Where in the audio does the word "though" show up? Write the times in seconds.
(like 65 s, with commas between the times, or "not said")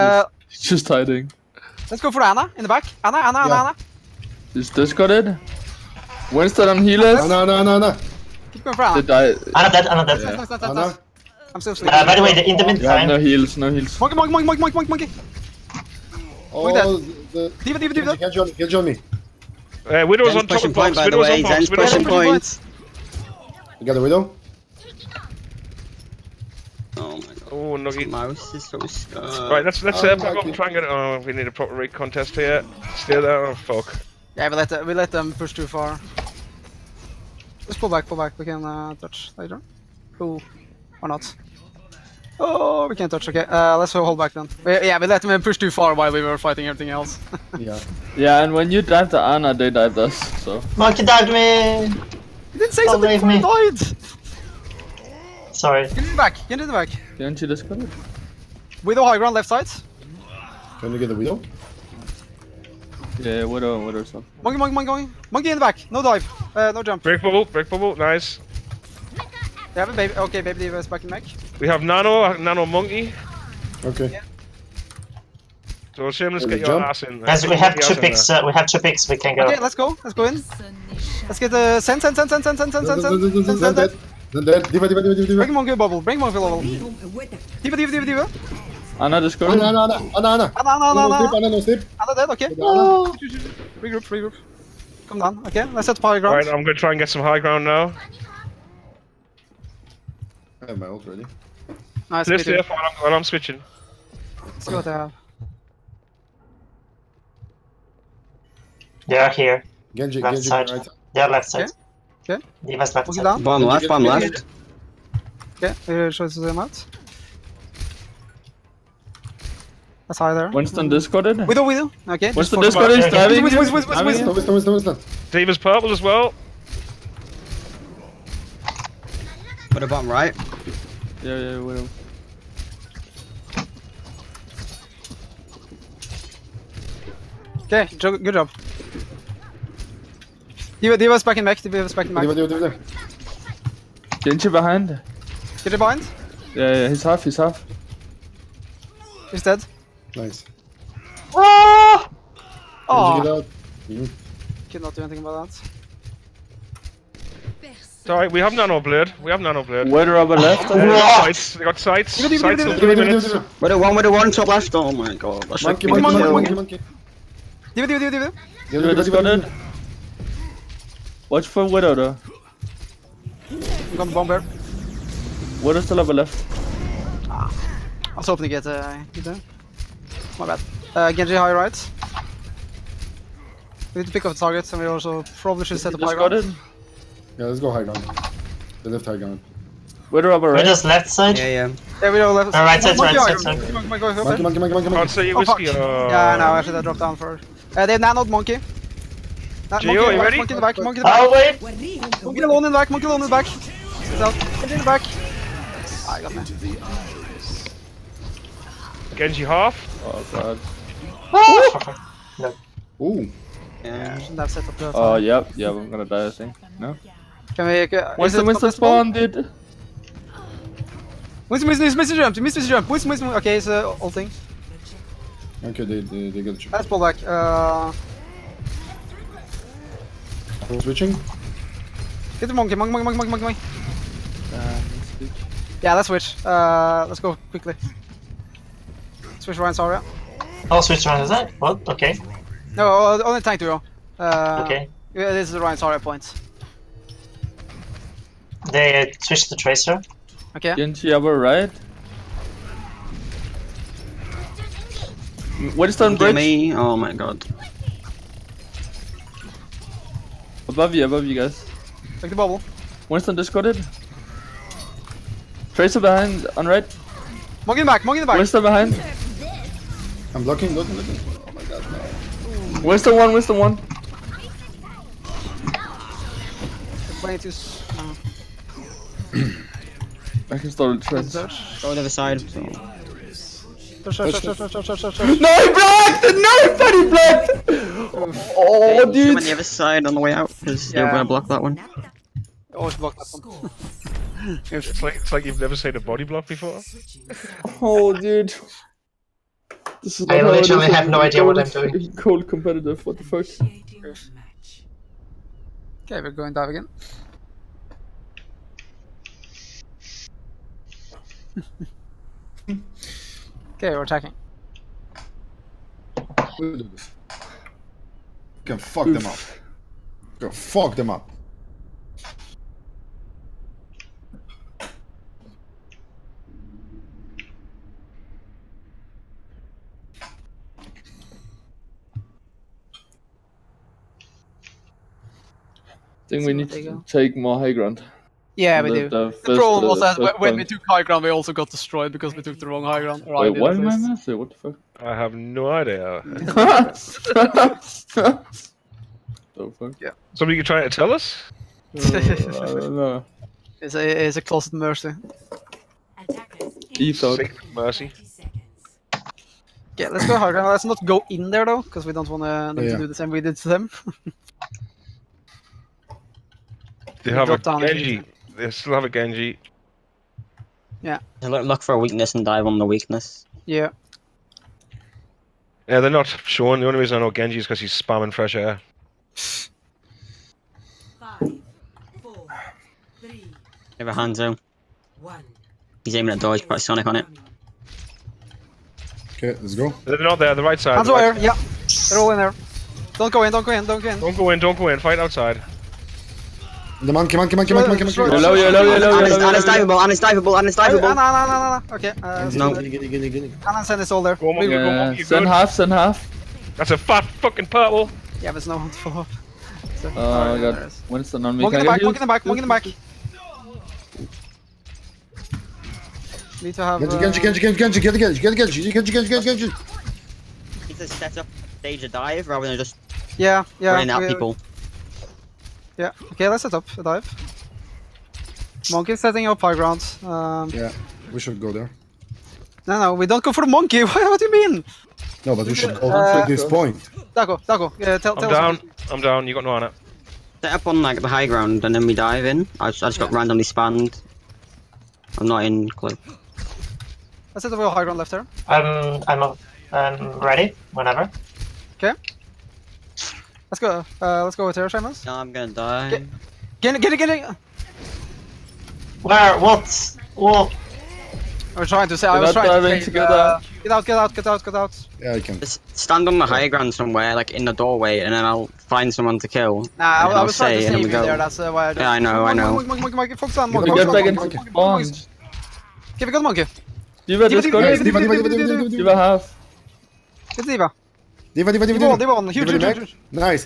171 s, 361 s.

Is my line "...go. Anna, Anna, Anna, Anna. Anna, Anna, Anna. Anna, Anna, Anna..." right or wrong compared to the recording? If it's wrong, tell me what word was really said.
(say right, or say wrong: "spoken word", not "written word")
right.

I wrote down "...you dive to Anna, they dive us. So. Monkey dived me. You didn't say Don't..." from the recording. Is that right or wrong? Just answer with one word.
right.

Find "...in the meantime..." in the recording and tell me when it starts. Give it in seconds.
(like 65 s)
12 s.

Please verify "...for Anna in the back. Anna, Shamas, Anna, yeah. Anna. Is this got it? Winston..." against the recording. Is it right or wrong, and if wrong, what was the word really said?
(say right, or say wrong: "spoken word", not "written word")
wrong: "Anna", not "Shamas".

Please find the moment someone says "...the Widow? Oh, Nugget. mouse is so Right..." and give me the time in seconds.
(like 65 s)
23 s.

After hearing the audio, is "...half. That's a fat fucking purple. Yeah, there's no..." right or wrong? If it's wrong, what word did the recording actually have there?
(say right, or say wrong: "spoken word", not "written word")
right.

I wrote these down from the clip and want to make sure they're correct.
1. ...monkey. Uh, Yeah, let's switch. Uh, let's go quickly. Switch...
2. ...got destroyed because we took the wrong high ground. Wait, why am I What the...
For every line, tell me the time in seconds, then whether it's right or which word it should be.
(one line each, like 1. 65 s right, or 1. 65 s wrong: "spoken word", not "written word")
1. 233 s right
2. 341 s right.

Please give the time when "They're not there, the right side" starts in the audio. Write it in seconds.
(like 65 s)
390 s.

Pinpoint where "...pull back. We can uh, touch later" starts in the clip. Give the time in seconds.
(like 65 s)
38 s.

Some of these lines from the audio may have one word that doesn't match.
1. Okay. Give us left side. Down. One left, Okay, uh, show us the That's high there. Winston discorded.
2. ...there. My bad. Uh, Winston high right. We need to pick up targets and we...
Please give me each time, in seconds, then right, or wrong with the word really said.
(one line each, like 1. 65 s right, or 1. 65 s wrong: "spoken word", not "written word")
1. 112 s right
2. 179 s wrong: "Genji", not "Winston".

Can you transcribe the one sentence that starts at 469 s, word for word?
Nah, I, I was trying to save you there.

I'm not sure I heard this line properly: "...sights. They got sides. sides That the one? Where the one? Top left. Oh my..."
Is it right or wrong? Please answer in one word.
wrong.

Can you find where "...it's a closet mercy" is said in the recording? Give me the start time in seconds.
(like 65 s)
354 s.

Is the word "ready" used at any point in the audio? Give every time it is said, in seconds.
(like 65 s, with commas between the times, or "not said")
101 s, 200 s, 450 s.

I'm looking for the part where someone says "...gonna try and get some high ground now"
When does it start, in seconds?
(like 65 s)
96 s.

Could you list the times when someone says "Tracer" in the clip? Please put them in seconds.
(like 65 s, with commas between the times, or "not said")
249 s, 265 s.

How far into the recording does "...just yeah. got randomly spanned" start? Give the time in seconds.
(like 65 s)
443 s.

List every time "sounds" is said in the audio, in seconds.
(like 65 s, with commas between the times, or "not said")
not said.